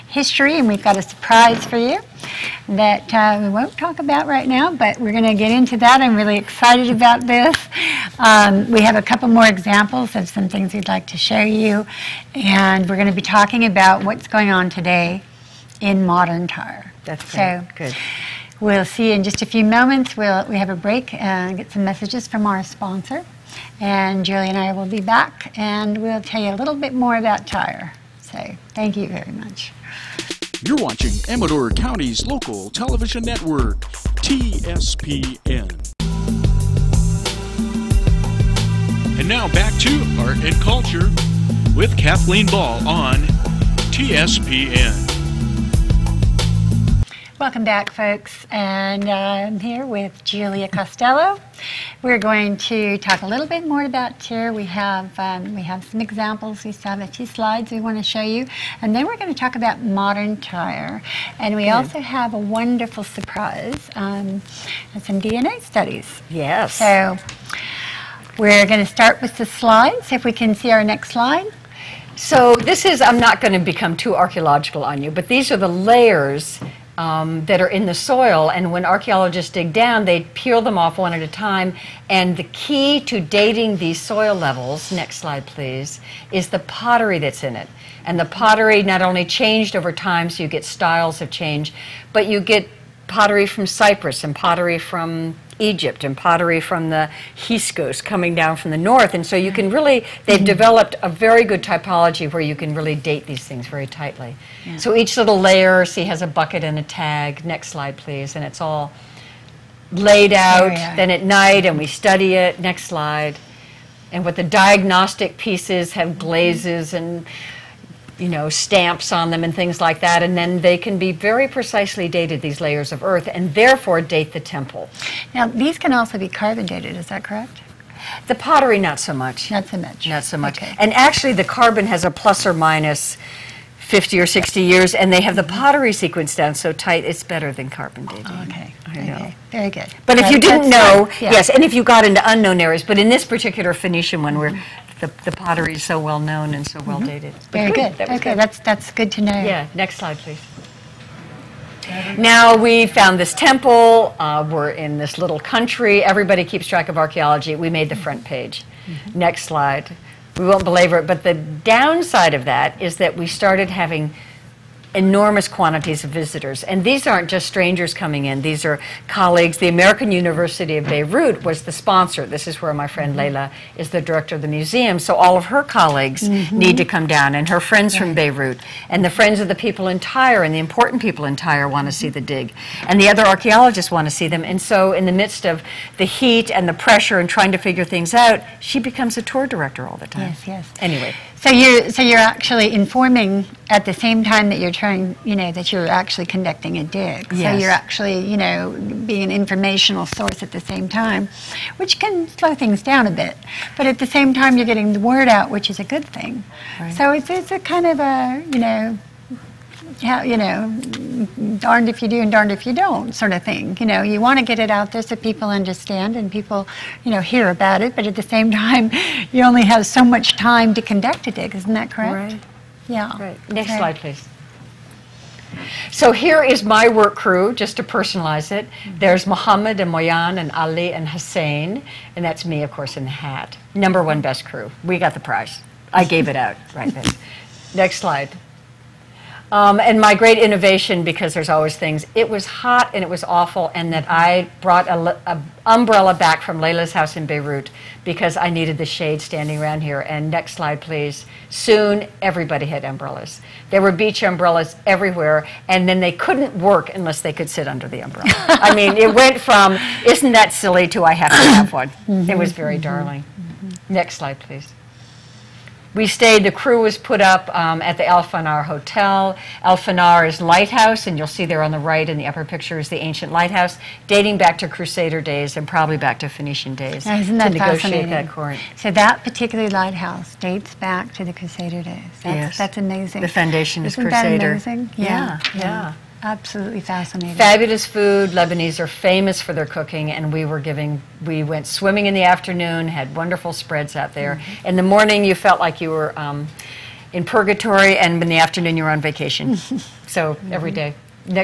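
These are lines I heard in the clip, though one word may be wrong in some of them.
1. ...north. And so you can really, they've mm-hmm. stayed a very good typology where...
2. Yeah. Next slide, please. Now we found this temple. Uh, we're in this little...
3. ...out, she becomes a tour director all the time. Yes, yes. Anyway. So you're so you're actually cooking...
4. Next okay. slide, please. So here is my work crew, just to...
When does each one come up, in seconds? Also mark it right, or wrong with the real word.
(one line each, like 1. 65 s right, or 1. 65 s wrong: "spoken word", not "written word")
1. 98 s wrong: "developed", not "stayed"
2. 149 s right
3. 188 s wrong: "informing", not "cooking"
4. 223 s right.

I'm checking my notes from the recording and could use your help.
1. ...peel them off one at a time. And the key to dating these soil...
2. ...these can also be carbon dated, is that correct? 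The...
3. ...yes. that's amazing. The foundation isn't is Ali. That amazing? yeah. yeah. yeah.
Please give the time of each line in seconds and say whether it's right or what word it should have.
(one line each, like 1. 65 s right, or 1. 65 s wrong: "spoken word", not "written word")
1. 80 s right
2. 125 s right
3. 282 s wrong: "Crusader", not "Ali".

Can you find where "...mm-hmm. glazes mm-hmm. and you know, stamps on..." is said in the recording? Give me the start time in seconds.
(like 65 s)
116 s.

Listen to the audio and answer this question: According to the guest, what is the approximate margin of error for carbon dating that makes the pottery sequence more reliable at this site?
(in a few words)
50 or 60 years.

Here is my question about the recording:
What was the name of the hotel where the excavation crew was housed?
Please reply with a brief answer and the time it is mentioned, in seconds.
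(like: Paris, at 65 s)
Al Fanar Hotel, at 268 s.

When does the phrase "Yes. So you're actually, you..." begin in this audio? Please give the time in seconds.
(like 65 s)
197 s.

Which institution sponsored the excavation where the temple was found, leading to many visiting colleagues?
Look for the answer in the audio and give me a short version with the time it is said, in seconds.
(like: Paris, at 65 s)
American University of Beirut, at 169 s.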